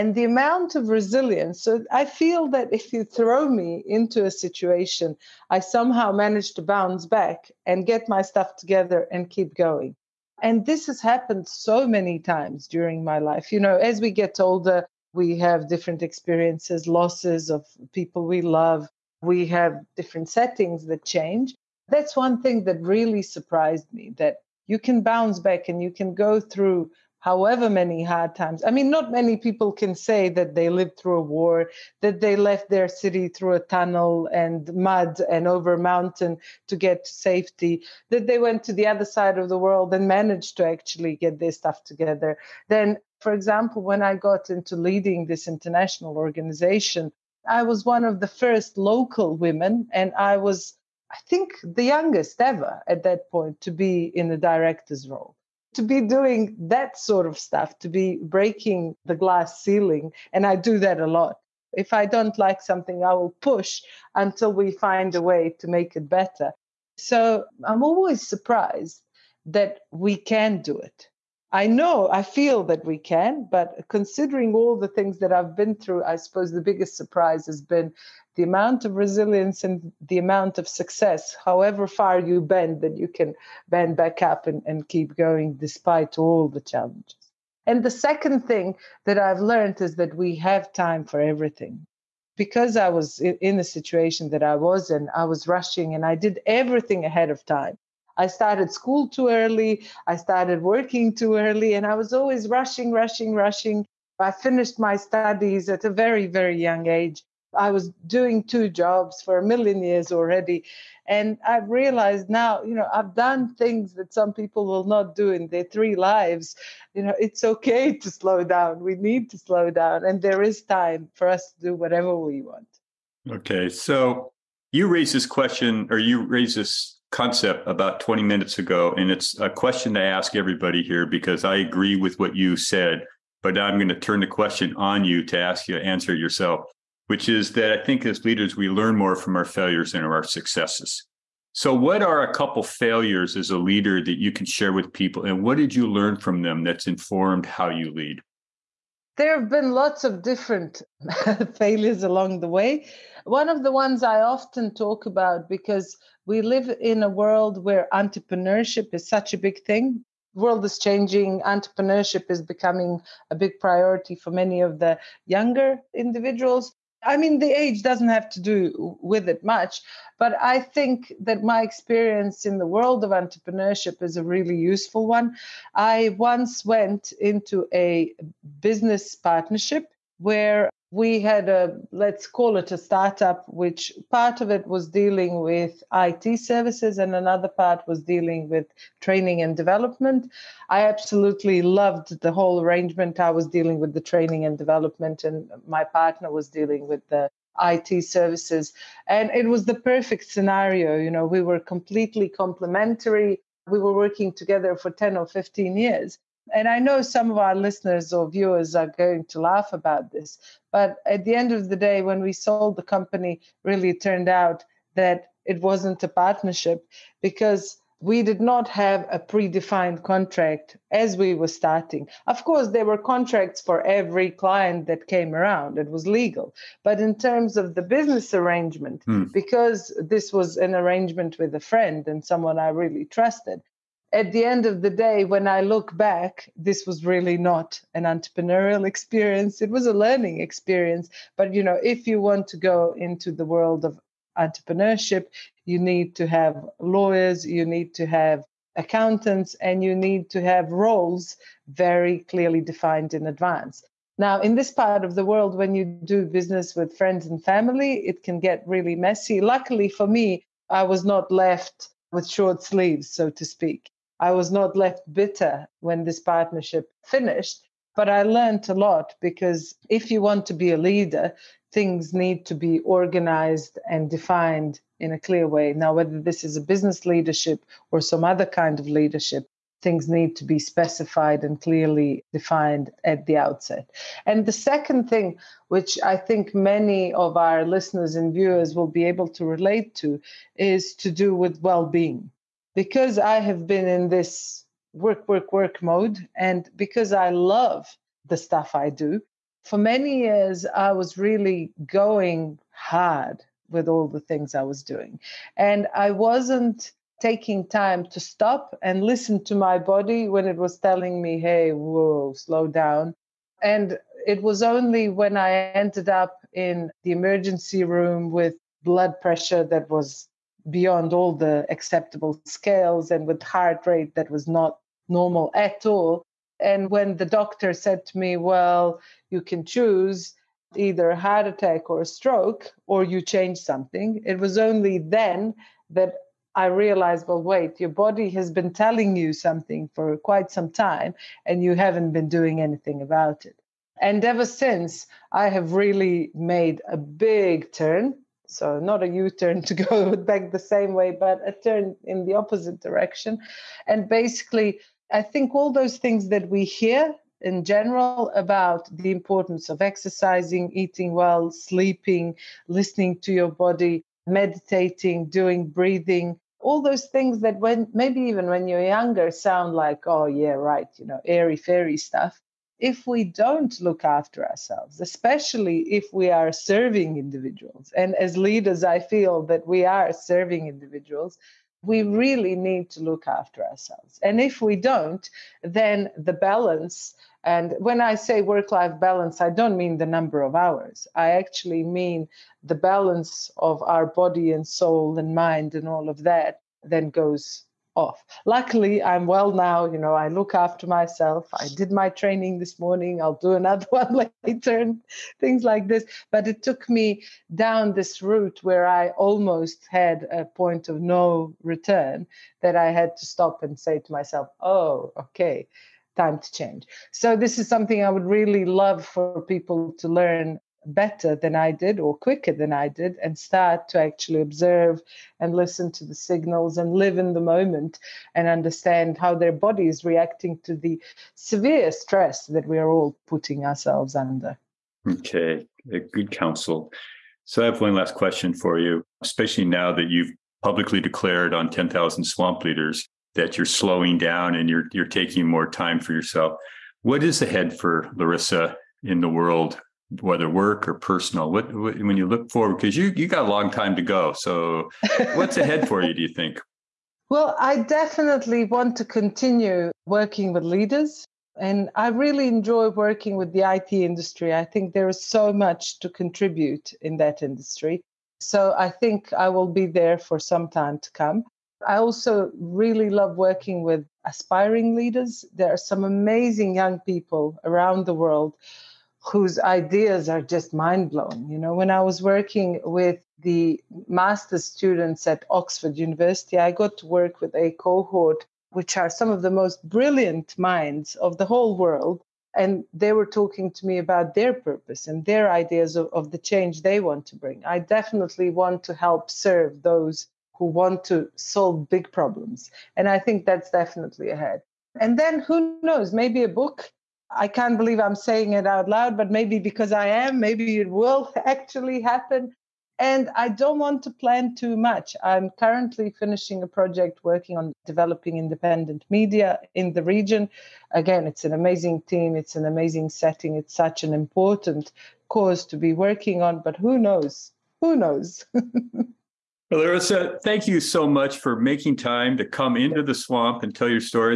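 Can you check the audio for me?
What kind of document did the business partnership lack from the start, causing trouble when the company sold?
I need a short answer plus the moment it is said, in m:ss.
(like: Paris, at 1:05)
predefined contract, at 3:39.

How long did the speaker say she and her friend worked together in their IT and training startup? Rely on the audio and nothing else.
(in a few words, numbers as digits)
10 or 15 years.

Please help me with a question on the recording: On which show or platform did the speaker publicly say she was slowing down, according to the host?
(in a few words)
10,000 swamp leaders.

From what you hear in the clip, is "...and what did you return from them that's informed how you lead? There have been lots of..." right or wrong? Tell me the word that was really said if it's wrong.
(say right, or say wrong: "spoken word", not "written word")
wrong: "learn", not "return".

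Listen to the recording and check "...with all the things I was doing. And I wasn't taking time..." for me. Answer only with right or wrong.
right.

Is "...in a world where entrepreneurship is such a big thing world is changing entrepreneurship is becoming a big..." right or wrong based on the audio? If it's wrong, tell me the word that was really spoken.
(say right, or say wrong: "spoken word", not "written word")
right.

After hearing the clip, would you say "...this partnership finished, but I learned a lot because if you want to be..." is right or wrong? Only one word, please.
right.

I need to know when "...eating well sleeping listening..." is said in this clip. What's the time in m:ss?
6:00.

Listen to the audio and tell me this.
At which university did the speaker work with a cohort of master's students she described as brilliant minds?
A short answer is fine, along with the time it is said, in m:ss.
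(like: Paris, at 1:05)
Oxford University, at 8:05.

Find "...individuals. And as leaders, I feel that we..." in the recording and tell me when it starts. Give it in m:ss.
6:17.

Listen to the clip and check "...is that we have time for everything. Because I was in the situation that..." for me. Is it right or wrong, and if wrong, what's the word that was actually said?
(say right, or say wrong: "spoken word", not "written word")
right.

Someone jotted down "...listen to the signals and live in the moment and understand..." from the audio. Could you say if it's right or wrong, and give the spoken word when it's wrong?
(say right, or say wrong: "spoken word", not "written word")
right.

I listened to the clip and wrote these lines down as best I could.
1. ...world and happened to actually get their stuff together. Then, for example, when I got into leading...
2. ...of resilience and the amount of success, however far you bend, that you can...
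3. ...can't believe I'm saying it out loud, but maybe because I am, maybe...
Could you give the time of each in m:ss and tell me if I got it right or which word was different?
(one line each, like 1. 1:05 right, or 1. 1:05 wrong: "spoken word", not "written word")
1. 0:39 wrong: "managed", not "happened"
2. 1:18 right
3. 8:27 right.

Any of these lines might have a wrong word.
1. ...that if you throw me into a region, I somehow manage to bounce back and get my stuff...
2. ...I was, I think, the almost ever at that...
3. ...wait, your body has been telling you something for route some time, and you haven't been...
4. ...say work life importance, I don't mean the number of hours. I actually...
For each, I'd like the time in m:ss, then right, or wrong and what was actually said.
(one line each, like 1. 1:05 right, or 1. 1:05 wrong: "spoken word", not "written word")
1. 0:02 wrong: "situation", not "region"
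2. 0:50 wrong: "youngest", not "almost"
3. 5:37 wrong: "quite", not "route"
4. 6:28 wrong: "balance", not "importance".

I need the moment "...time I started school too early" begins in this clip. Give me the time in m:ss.
1:37.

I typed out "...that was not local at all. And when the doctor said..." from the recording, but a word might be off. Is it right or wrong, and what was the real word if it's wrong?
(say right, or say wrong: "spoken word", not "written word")
wrong: "normal", not "local".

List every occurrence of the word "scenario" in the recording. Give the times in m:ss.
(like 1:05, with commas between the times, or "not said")
3:20.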